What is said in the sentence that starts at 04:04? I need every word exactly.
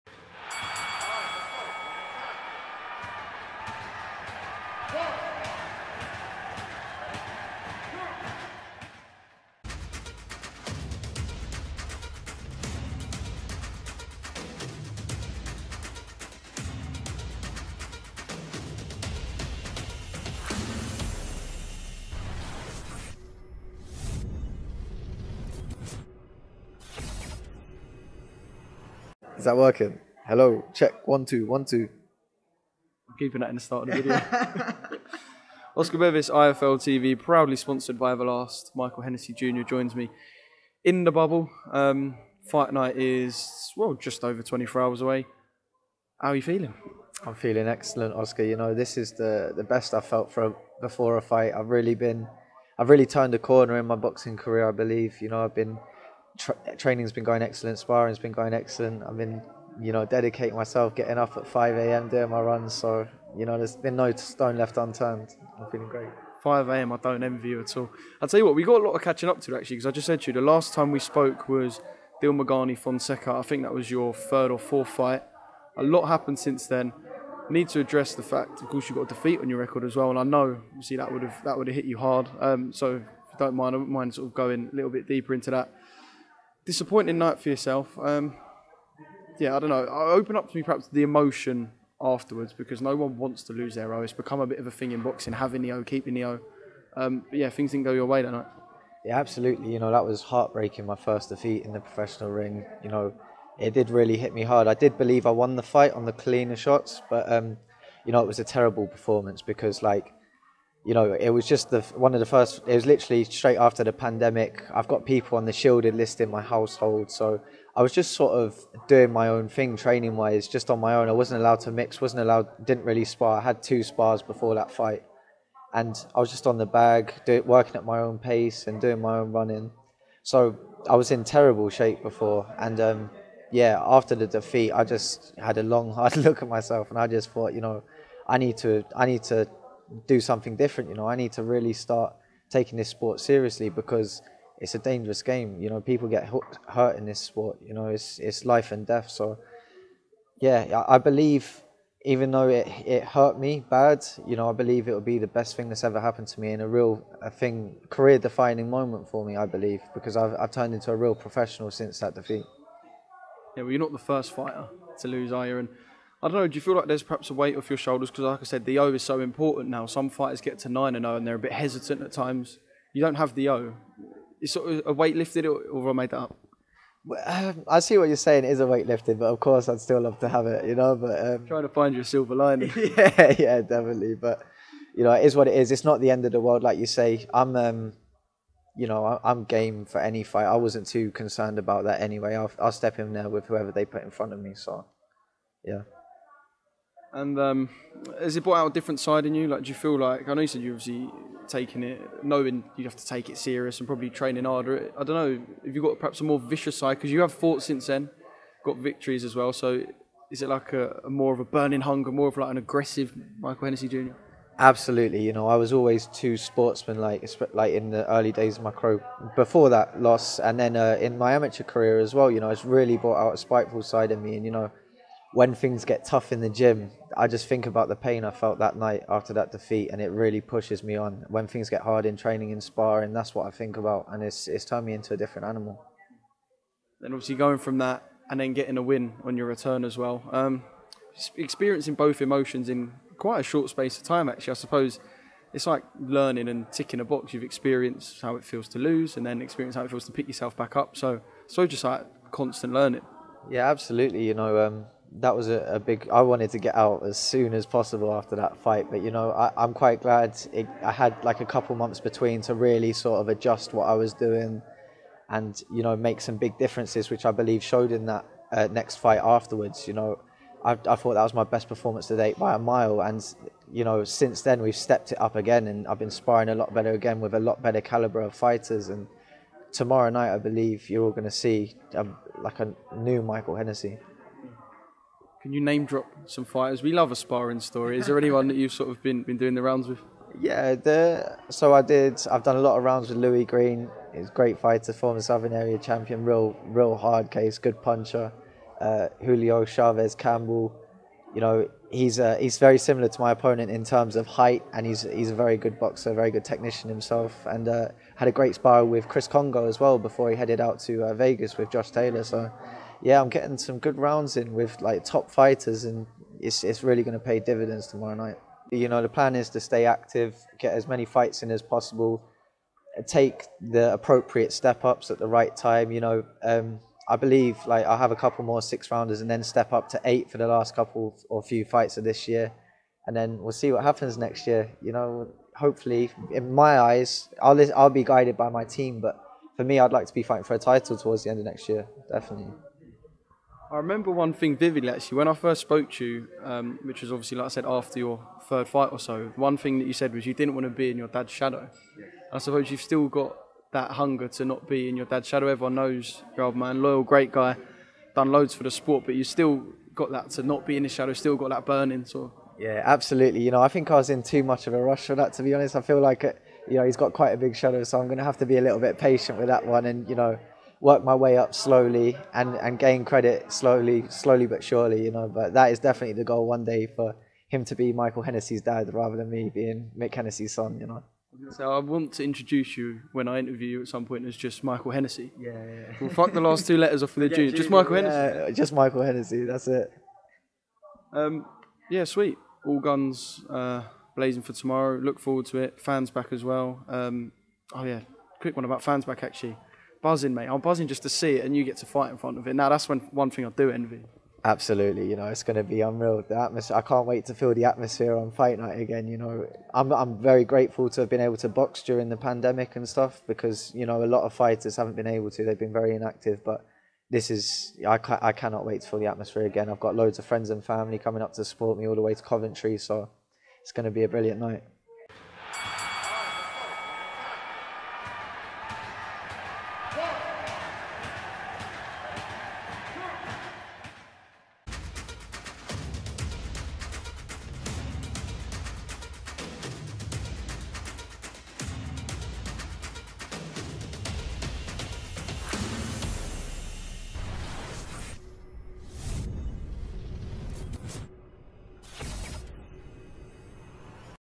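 Actually, I suppose it's like learning and ticking a box.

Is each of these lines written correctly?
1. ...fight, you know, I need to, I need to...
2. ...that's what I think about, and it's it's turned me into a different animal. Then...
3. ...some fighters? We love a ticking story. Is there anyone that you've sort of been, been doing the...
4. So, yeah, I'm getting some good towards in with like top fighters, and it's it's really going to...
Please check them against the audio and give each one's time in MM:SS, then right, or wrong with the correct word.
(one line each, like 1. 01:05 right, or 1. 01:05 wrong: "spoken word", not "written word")
1. 02:17 wrong: "thought", not "fight"
2. 03:53 right
3. 04:46 wrong: "sparring", not "ticking"
4. 05:12 wrong: "rounds", not "towards".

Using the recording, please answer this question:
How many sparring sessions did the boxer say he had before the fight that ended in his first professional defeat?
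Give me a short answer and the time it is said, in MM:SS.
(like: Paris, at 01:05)
2, at 02:03.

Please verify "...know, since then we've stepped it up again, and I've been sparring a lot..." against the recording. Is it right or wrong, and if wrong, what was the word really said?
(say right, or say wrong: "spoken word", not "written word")
right.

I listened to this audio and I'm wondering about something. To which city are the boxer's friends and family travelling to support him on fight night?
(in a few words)
Coventry.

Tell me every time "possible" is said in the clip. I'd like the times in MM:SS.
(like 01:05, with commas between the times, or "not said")
04:17, 05:21.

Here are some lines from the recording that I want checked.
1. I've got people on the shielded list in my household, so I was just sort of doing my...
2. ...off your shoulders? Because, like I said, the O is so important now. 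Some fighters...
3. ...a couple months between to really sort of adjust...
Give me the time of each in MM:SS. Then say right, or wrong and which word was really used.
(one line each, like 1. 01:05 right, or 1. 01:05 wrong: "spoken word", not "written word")
1. 01:54 right
2. 02:47 right
3. 04:21 right.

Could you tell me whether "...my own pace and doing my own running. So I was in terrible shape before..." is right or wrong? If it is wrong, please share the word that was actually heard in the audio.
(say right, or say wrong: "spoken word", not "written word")
right.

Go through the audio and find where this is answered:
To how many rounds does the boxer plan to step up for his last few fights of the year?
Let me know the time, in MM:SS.
05:30.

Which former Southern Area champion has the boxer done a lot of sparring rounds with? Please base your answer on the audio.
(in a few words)
Louis Greene.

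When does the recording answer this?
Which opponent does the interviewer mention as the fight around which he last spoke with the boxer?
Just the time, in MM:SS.
01:12.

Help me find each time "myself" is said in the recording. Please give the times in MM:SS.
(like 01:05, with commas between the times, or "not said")
01:00, 02:16.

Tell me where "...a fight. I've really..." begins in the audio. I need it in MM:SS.
00:51.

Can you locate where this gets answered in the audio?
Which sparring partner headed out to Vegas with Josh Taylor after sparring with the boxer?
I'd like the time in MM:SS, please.
05:09.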